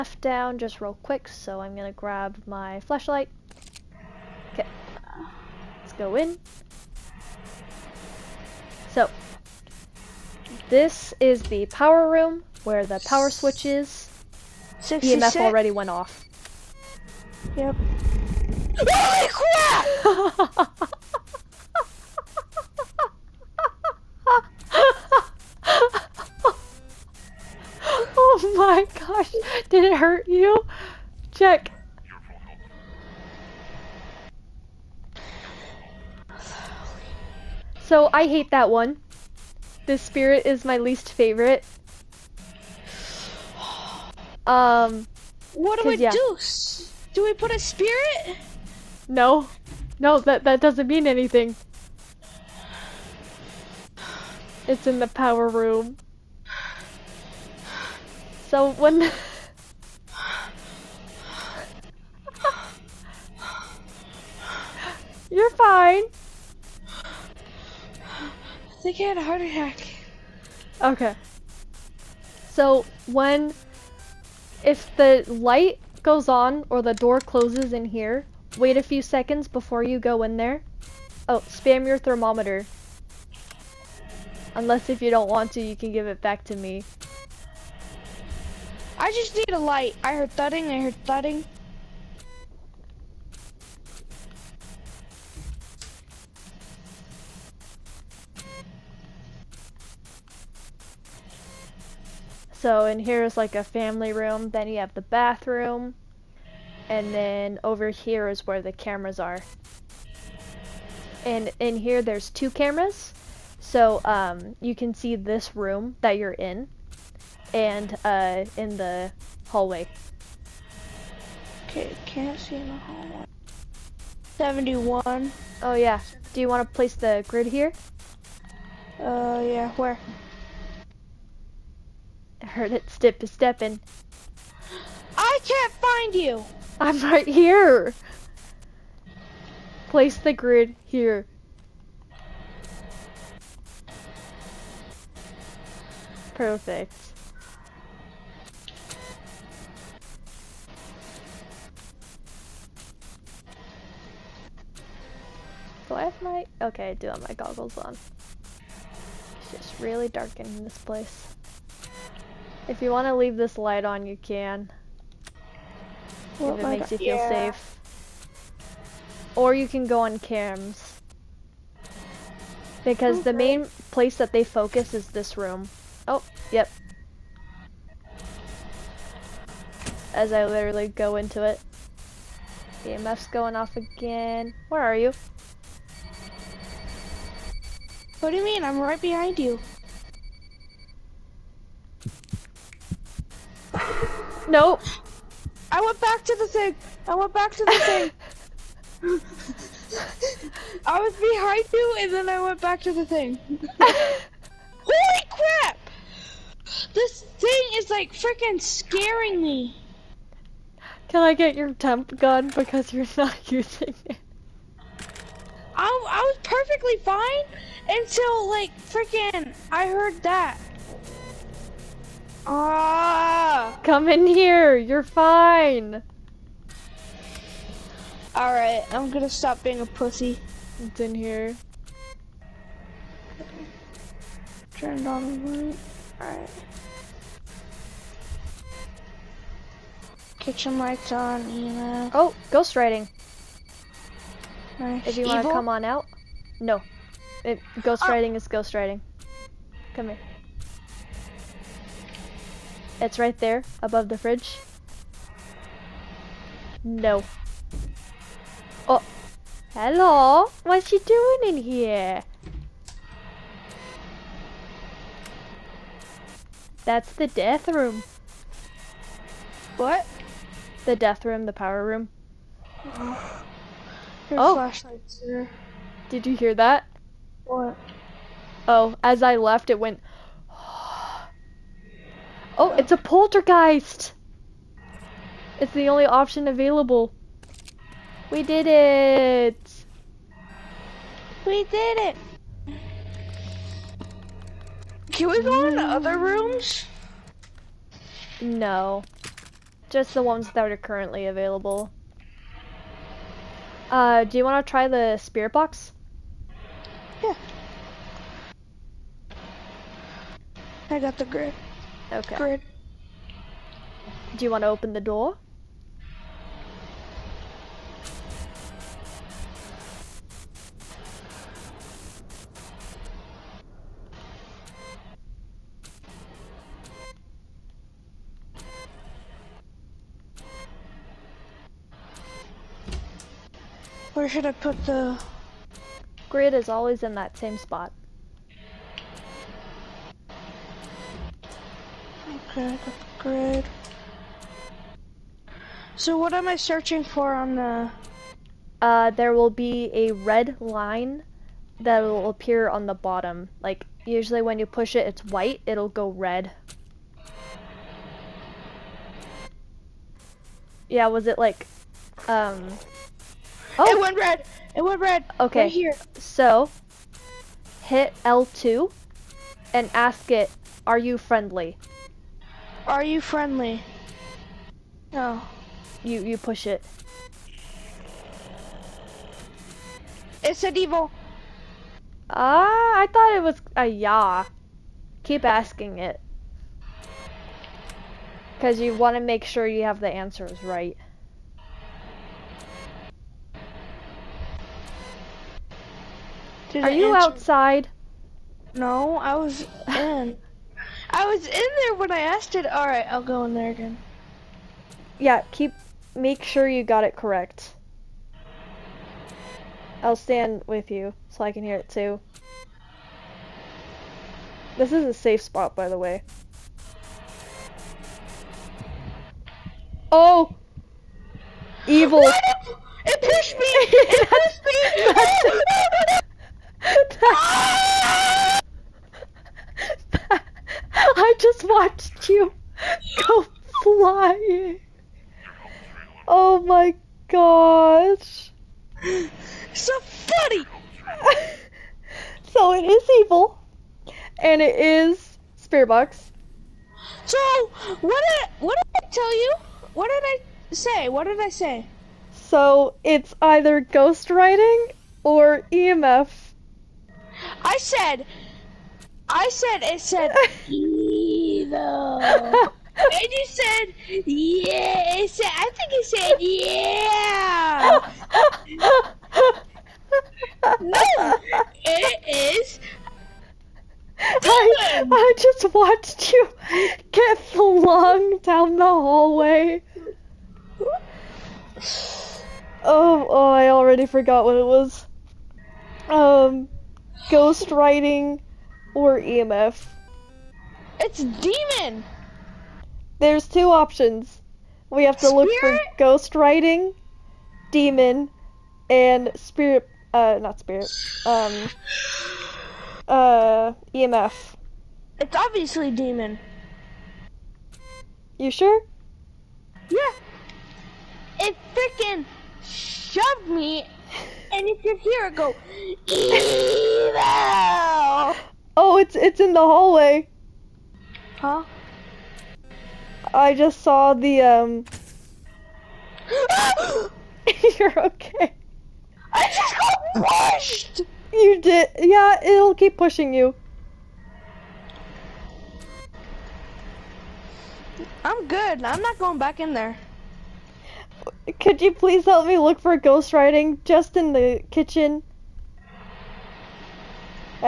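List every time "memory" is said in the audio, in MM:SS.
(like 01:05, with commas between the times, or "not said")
not said.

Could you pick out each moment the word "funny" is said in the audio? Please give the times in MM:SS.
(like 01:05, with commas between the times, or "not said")
07:20.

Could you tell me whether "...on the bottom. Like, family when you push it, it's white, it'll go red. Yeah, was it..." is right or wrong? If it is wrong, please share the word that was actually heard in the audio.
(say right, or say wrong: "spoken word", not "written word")
wrong: "usually", not "family".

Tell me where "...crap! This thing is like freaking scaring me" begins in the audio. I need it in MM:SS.
03:25.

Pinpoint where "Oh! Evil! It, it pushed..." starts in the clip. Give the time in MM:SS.
07:00.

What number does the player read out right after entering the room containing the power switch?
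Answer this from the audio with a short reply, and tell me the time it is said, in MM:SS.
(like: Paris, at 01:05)
66, at 00:14.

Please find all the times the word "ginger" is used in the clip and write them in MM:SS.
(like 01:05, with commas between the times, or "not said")
not said.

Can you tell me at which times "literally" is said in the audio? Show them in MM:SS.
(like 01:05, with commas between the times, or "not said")
03:00.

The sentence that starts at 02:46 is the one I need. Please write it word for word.
if it makes you feel yeah.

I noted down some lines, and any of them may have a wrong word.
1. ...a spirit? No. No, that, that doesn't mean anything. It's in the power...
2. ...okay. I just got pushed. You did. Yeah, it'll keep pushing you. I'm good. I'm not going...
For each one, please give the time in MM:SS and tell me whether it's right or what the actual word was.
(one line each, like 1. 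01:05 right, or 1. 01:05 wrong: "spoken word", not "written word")
1. 00:47 right
2. 08:48 right.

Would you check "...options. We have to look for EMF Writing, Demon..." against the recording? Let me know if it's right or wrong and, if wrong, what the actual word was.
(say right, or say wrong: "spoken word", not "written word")
wrong: "Ghost", not "EMF".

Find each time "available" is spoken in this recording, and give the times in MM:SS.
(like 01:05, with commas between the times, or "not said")
04:46, 05:01.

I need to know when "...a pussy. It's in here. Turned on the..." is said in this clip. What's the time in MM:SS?
03:49.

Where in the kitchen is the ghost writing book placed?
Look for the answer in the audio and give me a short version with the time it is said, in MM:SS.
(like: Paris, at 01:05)
Above the fridge, at 04:13.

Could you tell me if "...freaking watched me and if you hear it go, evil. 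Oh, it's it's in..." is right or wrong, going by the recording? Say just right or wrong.
wrong.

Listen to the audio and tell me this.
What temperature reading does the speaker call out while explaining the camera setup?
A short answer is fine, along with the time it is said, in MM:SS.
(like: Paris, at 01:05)
71, at 02:04.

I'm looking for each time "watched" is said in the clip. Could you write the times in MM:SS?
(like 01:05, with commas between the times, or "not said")
07:11, 07:55.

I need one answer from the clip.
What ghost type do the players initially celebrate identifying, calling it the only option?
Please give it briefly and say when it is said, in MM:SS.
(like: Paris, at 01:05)
Poltergeist, at 04:42.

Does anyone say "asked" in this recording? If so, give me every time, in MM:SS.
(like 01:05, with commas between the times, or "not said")
06:42.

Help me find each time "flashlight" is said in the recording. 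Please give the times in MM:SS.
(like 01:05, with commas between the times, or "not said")
00:02, 04:34.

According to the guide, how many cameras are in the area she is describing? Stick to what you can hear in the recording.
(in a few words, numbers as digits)
2.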